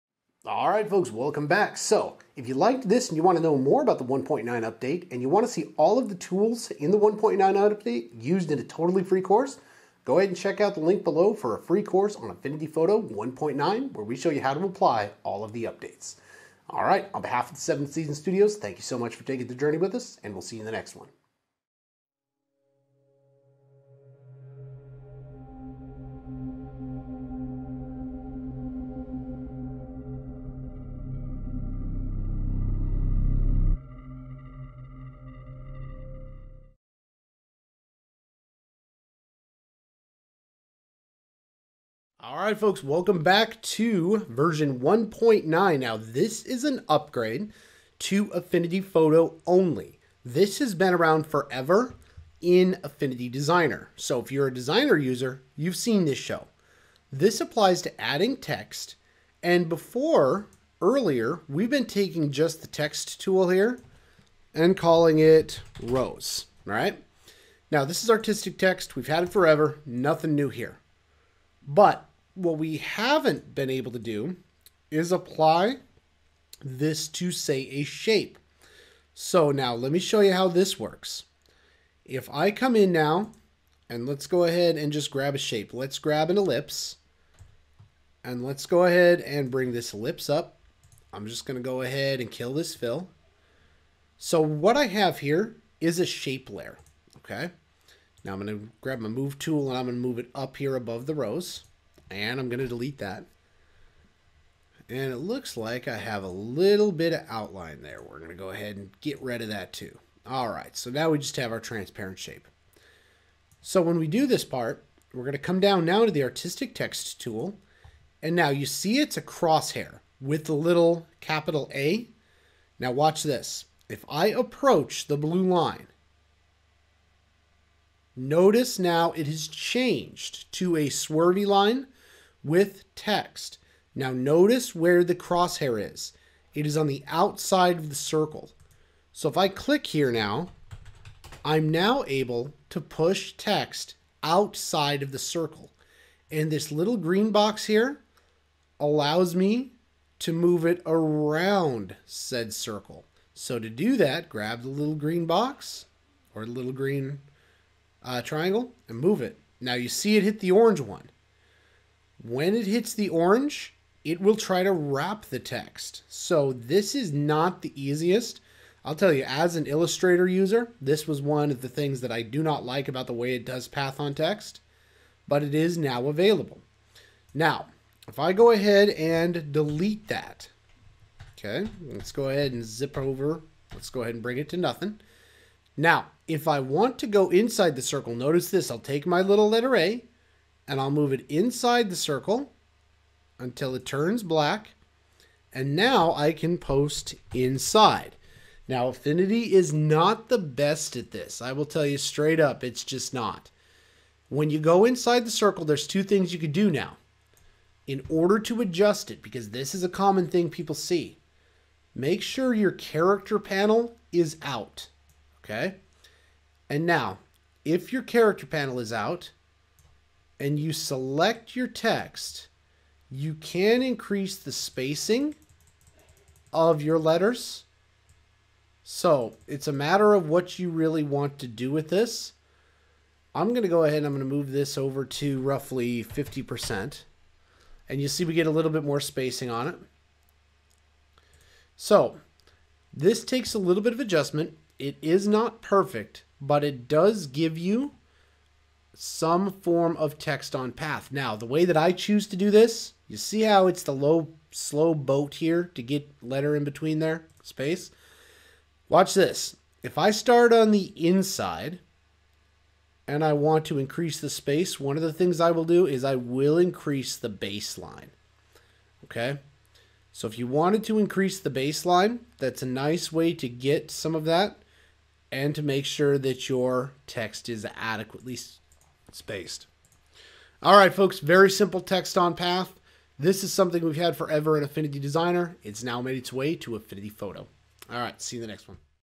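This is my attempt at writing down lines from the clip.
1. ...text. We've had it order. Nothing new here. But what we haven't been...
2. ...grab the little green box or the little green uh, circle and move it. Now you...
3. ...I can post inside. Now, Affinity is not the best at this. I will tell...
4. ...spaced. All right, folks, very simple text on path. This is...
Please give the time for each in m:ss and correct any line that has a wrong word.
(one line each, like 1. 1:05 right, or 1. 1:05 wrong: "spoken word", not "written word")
1. 1:08 wrong: "forever", not "order"
2. 2:34 wrong: "triangle", not "circle"
3. 3:16 right
4. 4:39 right.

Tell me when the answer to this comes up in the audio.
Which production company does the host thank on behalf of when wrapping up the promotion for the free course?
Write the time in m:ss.
0:17.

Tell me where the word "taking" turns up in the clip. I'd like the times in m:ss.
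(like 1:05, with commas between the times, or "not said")
0:19, 1:01.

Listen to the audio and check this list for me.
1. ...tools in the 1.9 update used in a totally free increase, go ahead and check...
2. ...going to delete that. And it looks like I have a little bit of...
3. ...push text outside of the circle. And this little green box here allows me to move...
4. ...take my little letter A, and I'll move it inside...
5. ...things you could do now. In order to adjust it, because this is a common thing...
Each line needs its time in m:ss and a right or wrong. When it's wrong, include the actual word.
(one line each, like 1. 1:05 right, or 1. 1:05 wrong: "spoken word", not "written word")
1. 0:06 wrong: "course", not "increase"
2. 1:42 right
3. 2:22 right
4. 3:08 right
5. 3:26 right.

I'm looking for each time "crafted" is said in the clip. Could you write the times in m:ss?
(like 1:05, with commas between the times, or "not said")
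not said.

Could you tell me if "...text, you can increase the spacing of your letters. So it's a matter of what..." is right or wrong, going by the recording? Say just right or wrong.
right.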